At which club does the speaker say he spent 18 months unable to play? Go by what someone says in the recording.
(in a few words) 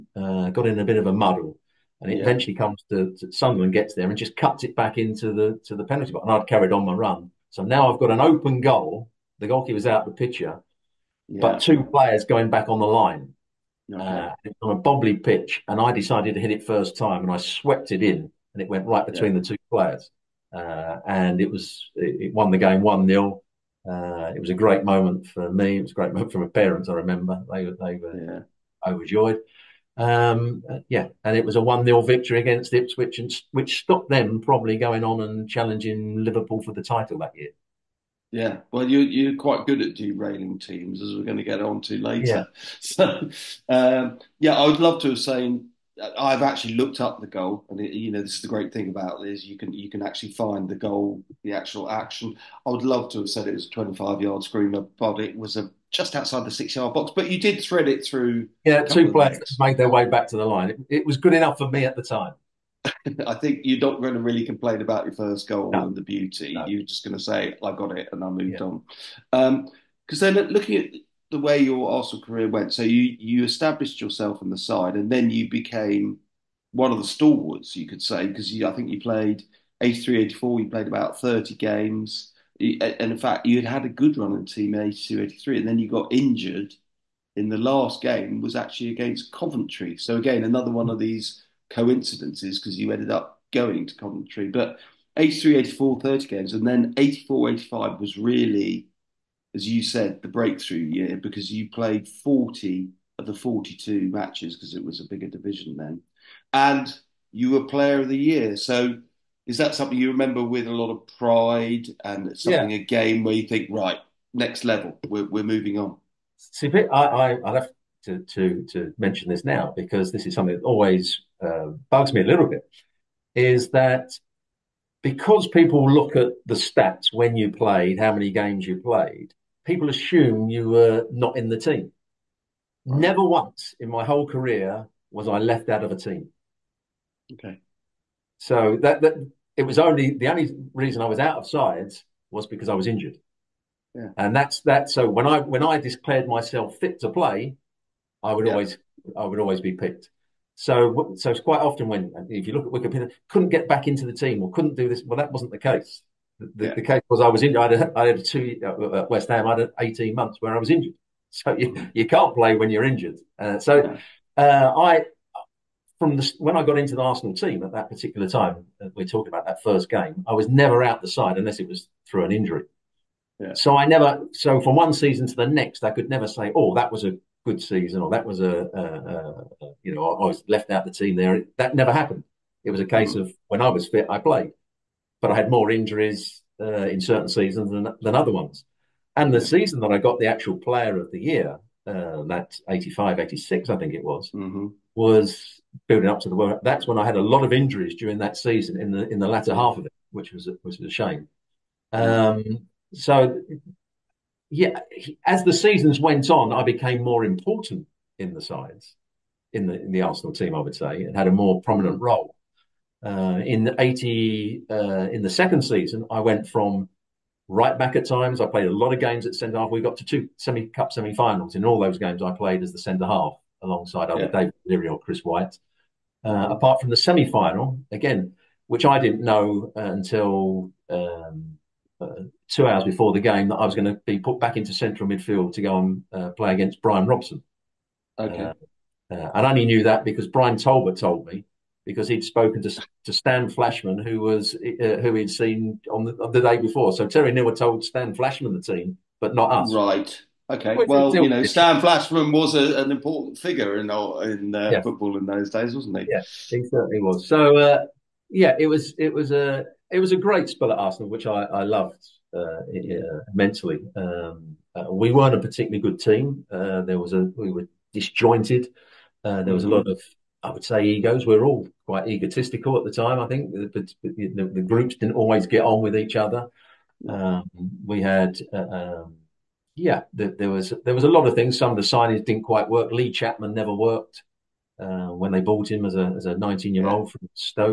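West Ham.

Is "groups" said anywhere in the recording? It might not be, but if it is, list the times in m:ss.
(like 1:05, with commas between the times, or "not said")
4:34.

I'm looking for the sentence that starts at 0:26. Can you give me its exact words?
I remember they were they were yeah.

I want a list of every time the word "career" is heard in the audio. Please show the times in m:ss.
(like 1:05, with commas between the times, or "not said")
1:12, 2:14.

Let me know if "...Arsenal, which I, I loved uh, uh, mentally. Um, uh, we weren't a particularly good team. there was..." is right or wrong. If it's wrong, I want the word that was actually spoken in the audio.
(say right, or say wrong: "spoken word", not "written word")
right.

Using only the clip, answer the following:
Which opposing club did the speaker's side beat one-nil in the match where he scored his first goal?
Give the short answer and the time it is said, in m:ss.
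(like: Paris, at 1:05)
Ipswich, at 0:32.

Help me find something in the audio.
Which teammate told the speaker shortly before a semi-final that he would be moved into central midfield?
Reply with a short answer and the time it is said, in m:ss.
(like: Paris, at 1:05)
Brian Talbot, at 4:00.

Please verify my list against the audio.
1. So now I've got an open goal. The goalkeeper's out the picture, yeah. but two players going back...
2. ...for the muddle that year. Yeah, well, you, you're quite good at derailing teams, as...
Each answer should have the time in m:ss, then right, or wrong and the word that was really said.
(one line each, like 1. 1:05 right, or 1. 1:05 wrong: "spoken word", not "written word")
1. 0:07 right
2. 0:36 wrong: "title", not "muddle".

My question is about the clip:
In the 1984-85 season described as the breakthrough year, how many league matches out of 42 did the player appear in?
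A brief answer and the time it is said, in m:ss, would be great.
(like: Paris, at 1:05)
40, at 1:42.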